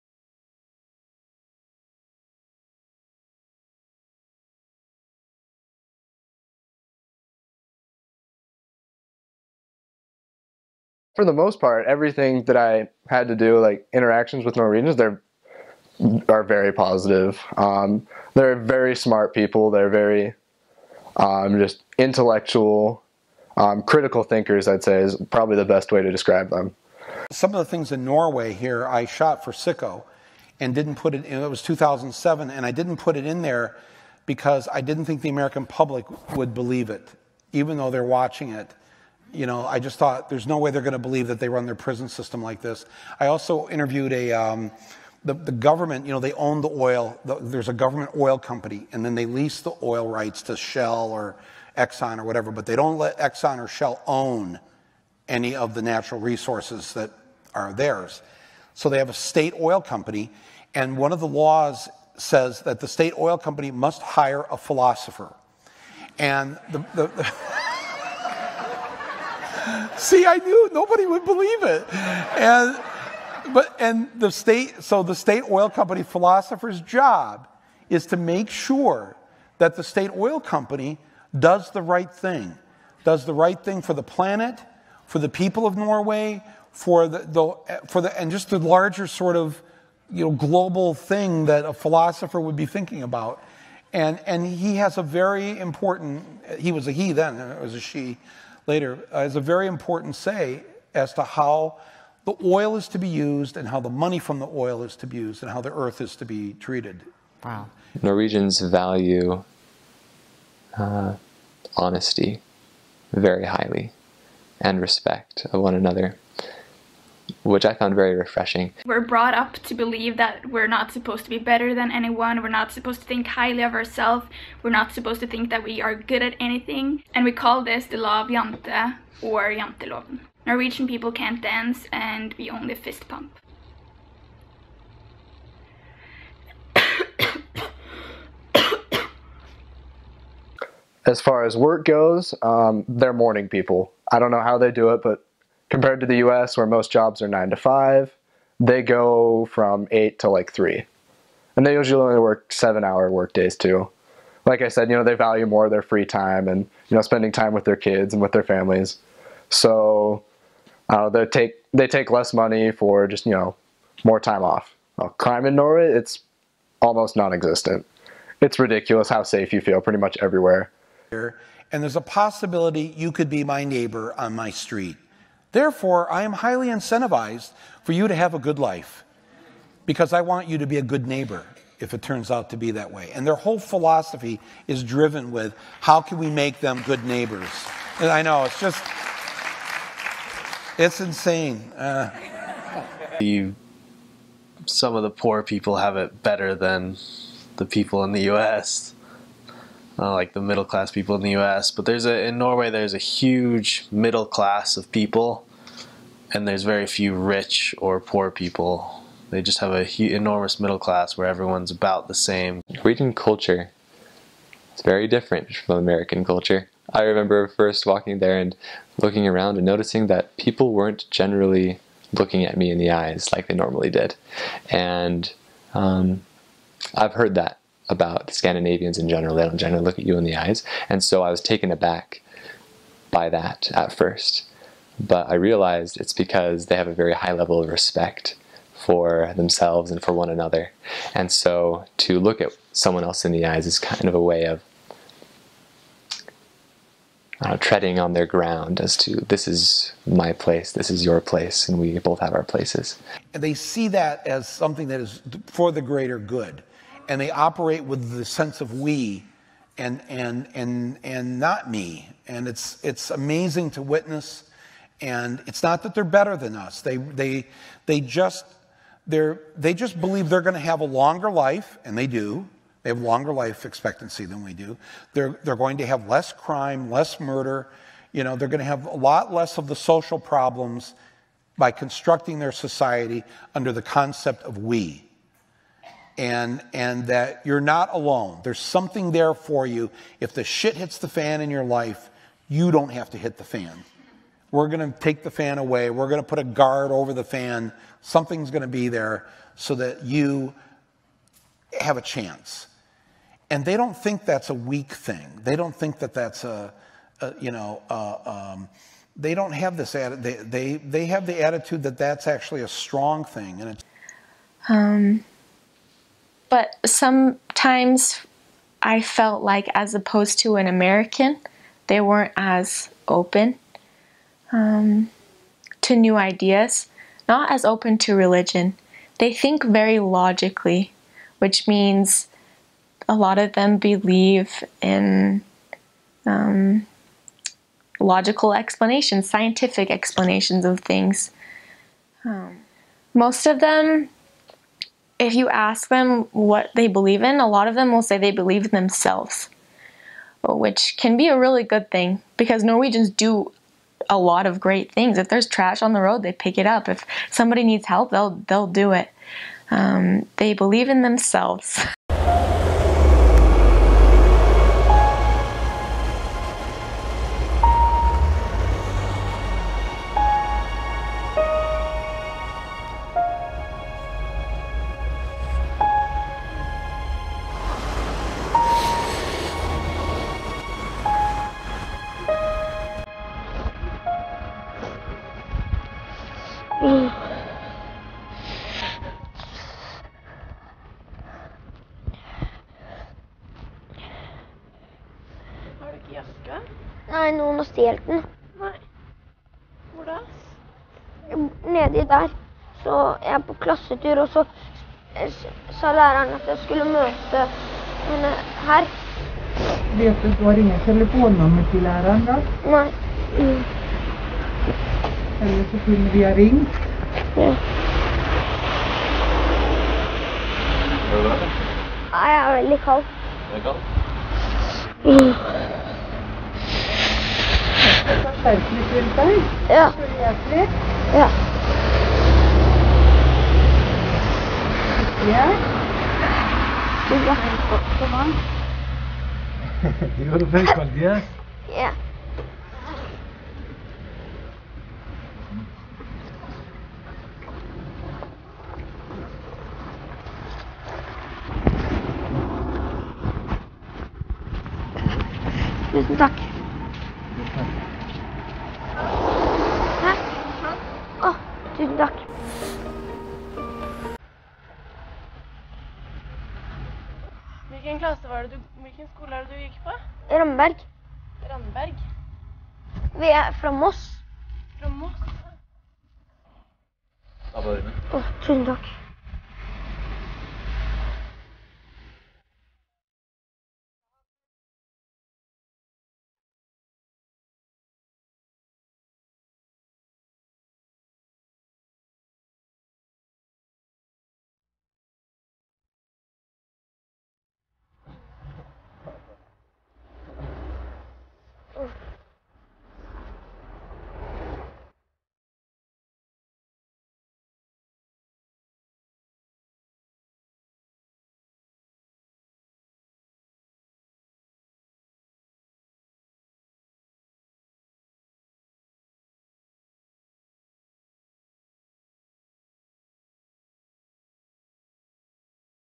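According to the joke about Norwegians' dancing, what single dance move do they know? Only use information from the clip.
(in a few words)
Fist pump.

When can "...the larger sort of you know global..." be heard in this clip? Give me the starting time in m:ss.
1:28.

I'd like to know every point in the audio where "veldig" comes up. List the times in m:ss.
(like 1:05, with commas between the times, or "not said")
7:02, 7:20.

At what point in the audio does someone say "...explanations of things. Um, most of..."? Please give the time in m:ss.
5:39.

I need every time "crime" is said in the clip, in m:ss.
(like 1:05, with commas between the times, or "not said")
2:45, 4:36.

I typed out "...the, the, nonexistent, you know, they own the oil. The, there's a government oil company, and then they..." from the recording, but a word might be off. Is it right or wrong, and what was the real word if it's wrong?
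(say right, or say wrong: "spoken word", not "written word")
wrong: "government", not "nonexistent".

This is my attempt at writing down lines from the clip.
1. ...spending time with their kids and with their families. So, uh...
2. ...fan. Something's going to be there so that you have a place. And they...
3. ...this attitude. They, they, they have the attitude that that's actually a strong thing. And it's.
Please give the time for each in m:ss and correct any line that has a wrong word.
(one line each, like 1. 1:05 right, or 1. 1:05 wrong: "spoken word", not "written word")
1. 2:37 right
2. 4:57 wrong: "chance", not "place"
3. 5:09 right.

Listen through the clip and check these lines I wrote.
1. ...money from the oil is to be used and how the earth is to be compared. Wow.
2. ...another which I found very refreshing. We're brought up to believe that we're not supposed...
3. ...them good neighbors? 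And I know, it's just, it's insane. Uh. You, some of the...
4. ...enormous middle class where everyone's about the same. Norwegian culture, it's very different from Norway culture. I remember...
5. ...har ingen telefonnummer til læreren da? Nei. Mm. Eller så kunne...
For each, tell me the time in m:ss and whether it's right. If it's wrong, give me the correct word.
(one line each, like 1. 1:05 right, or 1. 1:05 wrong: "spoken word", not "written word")
1. 1:43 wrong: "treated", not "compared"
2. 1:55 right
3. 3:06 right
4. 3:30 wrong: "American", not "Norway"
5. 6:50 right.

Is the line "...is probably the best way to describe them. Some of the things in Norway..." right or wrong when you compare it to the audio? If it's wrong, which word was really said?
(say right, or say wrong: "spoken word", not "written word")
right.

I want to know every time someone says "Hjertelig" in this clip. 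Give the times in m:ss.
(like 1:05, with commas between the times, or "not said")
7:10.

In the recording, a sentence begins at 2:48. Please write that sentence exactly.
It's ridiculous how safe you feel pretty much everywhere.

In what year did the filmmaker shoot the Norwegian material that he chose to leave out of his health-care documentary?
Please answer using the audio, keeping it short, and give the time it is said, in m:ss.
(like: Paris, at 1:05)
2007, at 0:31.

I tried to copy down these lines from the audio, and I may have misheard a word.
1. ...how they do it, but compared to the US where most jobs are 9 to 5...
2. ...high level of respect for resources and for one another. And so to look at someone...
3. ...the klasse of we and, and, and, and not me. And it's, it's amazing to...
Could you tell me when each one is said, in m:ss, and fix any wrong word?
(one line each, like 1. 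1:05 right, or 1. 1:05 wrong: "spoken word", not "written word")
1. 2:24 right
2. 3:57 wrong: "themselves", not "resources"
3. 4:18 wrong: "sense", not "klasse".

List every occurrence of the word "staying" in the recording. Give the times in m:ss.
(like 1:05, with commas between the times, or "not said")
not said.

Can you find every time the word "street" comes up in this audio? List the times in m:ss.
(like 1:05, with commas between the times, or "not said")
2:54.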